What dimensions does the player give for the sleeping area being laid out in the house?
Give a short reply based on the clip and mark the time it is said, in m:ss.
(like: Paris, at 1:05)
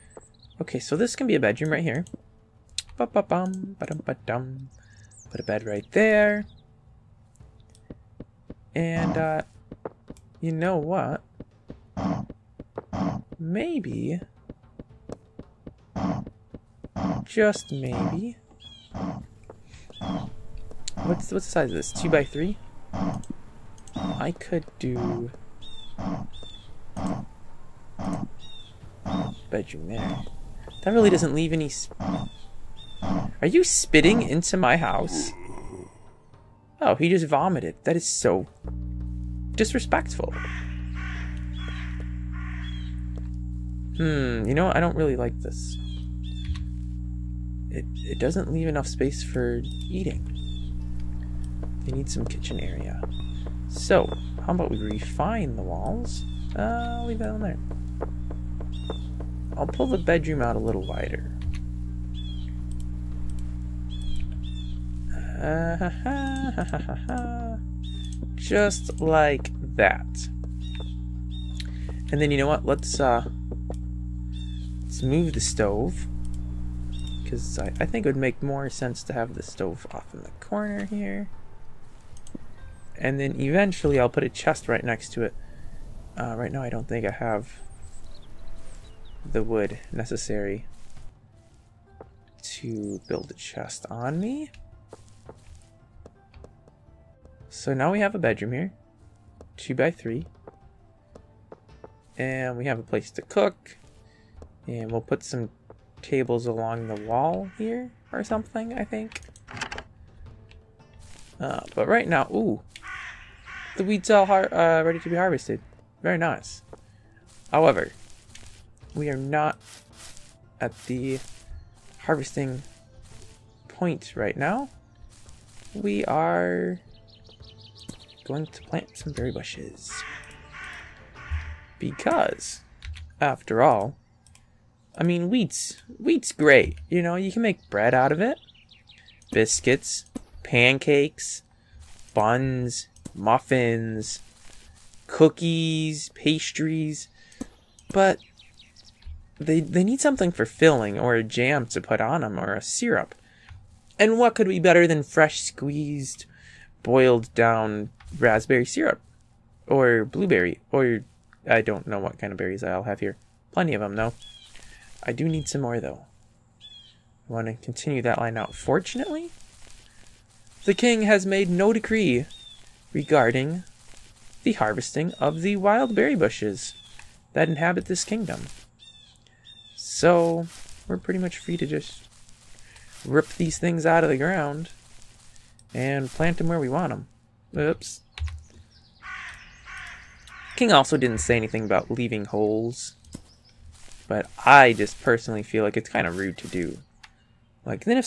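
2 by 3, at 0:21.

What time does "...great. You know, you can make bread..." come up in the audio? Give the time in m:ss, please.
2:16.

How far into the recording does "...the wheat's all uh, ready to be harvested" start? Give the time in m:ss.
1:53.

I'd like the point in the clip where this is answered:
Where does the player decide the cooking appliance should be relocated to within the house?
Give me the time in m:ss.
1:19.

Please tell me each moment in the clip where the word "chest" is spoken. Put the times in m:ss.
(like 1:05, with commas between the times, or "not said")
1:24, 1:33.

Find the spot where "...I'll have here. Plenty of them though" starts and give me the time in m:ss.
2:42.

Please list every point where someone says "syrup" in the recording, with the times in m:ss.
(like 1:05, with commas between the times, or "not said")
2:32, 2:38.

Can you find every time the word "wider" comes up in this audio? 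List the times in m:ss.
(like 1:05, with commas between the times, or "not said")
1:00.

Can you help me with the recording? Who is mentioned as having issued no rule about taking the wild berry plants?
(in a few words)
the king.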